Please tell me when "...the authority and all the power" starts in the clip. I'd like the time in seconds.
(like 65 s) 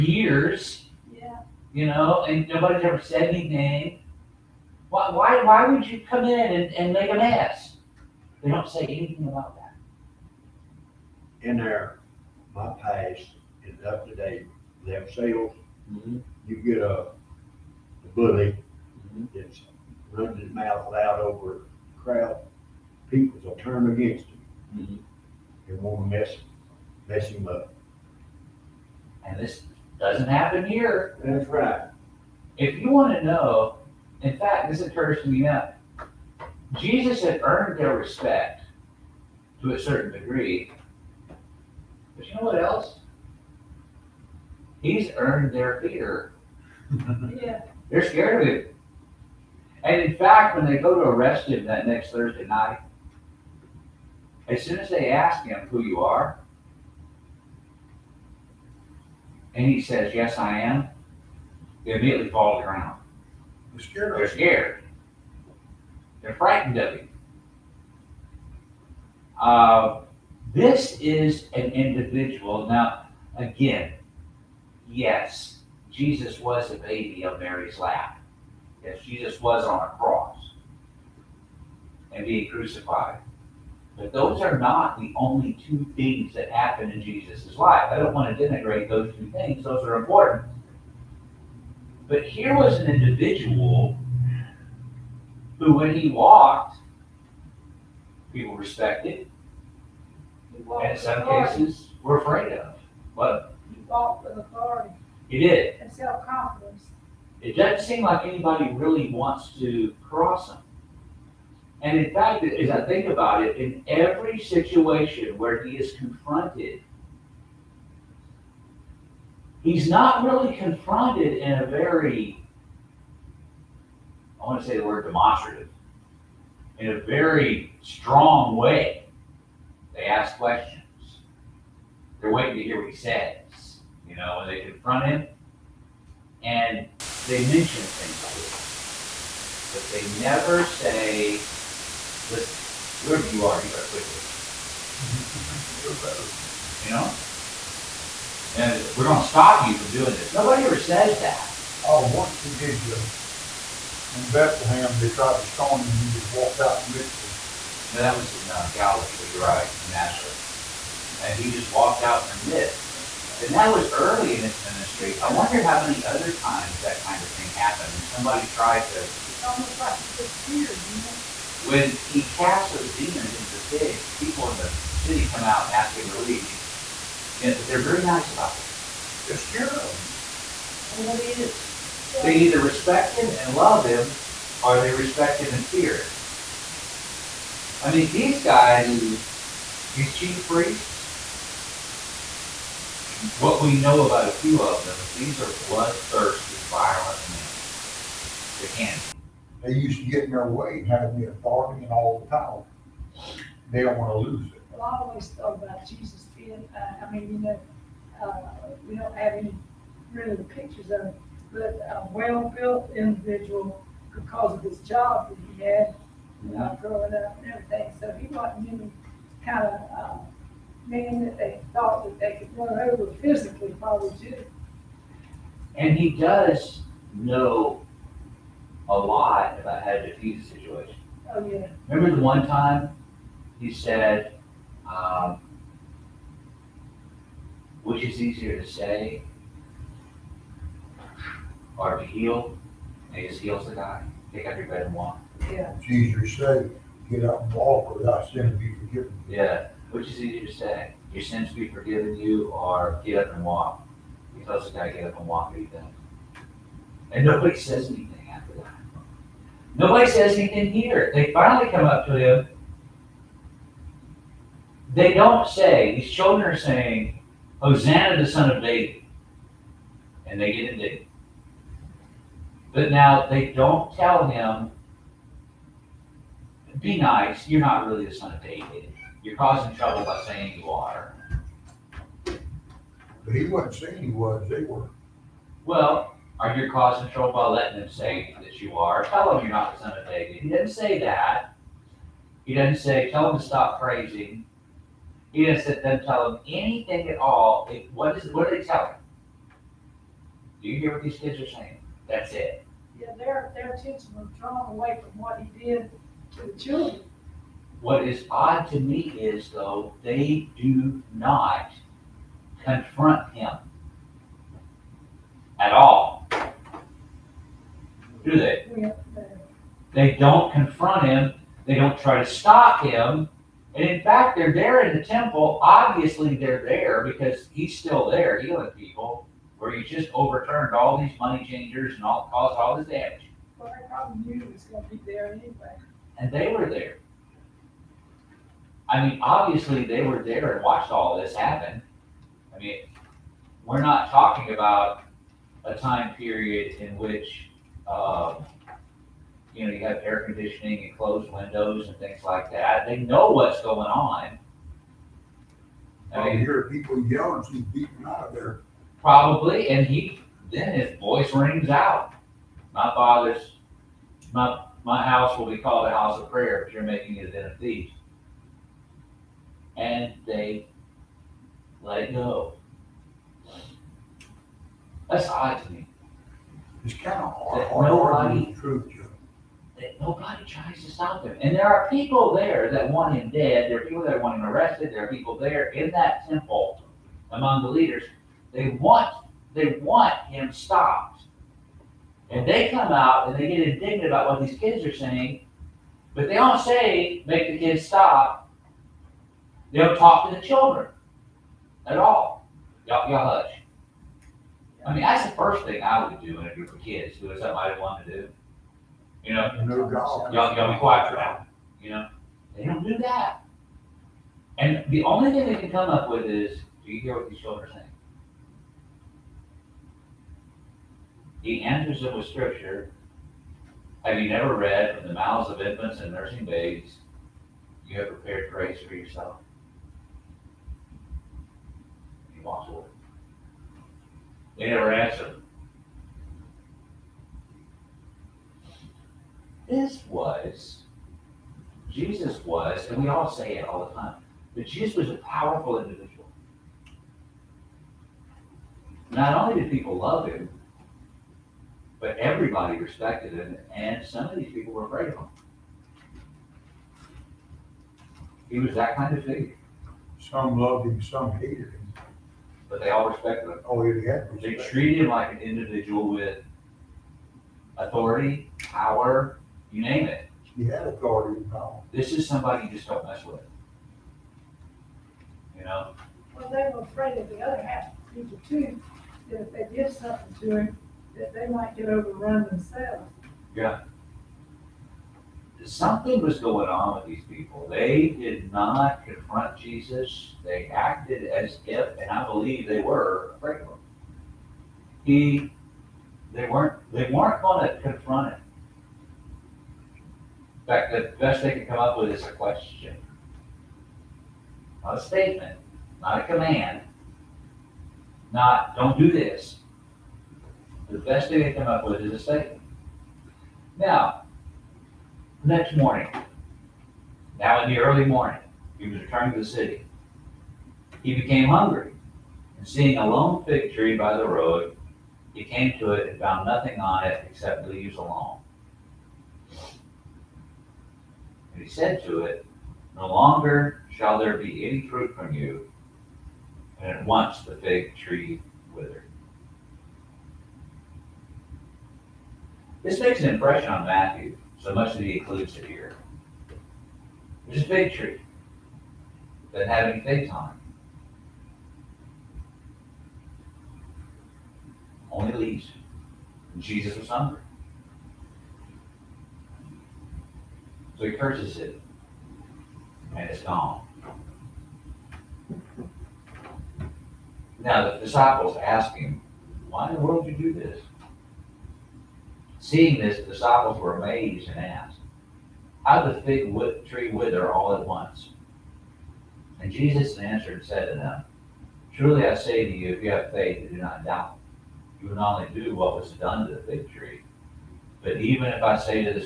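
201 s.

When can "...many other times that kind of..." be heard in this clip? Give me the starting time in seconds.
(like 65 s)
165 s.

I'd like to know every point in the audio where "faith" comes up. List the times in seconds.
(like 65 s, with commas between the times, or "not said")
583 s.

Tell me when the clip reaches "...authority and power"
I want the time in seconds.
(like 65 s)
470 s.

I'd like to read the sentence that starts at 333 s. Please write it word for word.
Well, I probably knew he was going to be there anyway and they were there.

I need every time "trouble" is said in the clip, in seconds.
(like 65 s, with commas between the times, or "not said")
279 s, 287 s.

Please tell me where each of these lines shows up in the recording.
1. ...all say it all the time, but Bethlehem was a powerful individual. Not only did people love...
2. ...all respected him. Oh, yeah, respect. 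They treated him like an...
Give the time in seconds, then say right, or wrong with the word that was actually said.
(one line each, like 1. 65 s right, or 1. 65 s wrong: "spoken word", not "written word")
1. 443 s wrong: "Jesus", not "Bethlehem"
2. 462 s right.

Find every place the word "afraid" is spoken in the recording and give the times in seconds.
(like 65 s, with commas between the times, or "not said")
102 s, 454 s, 476 s, 493 s.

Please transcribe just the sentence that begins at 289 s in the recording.
Tell them you're not the son of David.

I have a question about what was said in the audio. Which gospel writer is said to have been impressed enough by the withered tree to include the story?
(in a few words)
Matthew.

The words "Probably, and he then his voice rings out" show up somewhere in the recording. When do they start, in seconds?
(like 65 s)
359 s.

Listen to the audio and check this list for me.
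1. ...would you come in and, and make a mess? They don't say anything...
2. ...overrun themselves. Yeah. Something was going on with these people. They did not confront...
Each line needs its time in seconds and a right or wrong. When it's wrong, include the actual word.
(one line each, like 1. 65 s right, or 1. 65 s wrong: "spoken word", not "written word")
1. 5 s right
2. 481 s right.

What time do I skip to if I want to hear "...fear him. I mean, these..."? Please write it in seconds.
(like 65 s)
185 s.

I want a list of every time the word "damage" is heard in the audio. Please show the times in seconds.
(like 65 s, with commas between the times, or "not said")
332 s.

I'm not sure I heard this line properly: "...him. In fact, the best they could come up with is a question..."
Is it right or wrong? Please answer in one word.
right.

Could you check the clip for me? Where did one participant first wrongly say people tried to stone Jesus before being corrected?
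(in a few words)
Bethlehem.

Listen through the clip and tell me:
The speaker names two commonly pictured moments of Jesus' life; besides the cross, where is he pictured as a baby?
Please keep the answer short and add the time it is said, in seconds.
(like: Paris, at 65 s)
On Mary's lap, at 77 s.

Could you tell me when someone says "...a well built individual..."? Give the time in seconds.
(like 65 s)
211 s.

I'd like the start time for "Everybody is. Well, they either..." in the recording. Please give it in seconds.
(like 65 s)
180 s.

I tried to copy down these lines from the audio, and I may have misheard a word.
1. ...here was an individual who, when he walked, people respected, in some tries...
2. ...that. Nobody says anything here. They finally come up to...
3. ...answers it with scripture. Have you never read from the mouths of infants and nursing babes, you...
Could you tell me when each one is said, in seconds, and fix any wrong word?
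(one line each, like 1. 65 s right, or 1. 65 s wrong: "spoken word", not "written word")
1. 92 s wrong: "cases", not "tries"
2. 258 s right
3. 421 s right.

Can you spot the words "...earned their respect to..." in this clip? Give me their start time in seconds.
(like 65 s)
37 s.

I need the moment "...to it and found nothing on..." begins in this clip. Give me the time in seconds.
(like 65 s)
525 s.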